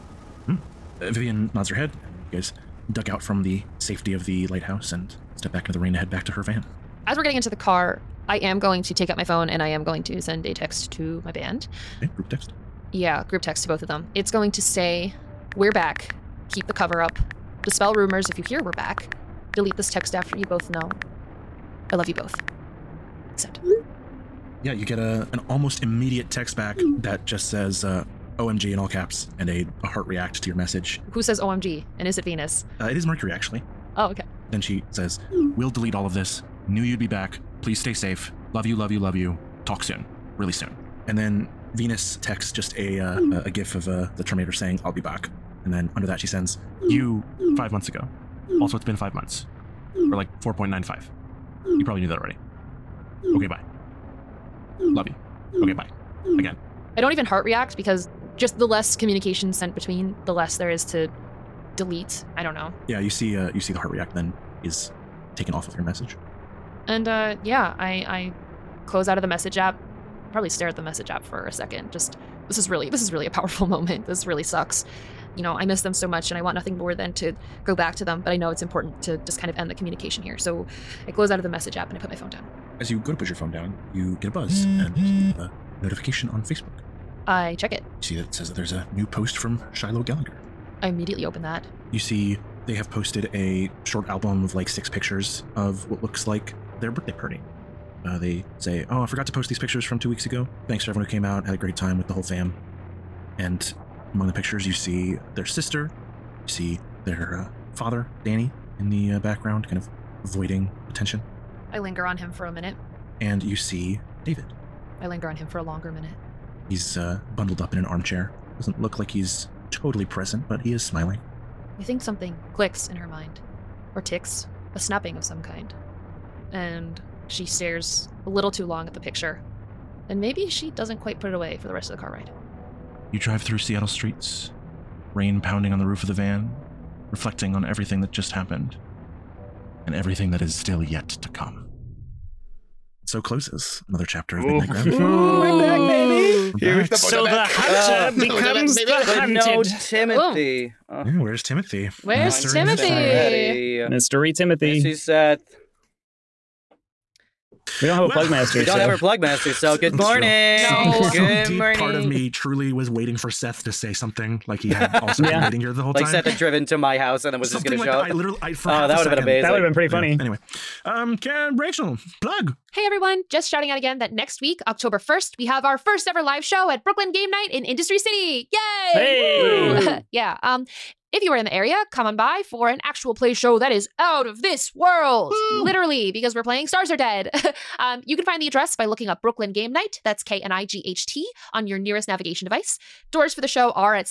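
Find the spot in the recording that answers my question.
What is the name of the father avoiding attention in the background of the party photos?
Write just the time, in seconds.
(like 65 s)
108 s.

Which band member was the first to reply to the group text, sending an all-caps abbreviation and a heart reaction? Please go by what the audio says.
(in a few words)
Mercury.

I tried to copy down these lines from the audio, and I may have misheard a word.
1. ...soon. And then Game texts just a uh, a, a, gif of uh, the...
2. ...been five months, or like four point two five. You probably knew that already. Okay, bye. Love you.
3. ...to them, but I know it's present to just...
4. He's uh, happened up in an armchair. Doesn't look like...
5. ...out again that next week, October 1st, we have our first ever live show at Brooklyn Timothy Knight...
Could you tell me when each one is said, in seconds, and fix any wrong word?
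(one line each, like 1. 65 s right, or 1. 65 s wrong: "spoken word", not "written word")
1. 40 s wrong: "Venus", not "Game"
2. 48 s wrong: "nine", not "two"
3. 77 s wrong: "important", not "present"
4. 116 s wrong: "bundled", not "happened"
5. 173 s wrong: "Game", not "Timothy".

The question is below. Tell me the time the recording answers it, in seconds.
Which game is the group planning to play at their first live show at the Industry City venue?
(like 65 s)
186 s.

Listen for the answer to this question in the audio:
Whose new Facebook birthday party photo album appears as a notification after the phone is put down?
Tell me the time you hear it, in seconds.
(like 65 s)
89 s.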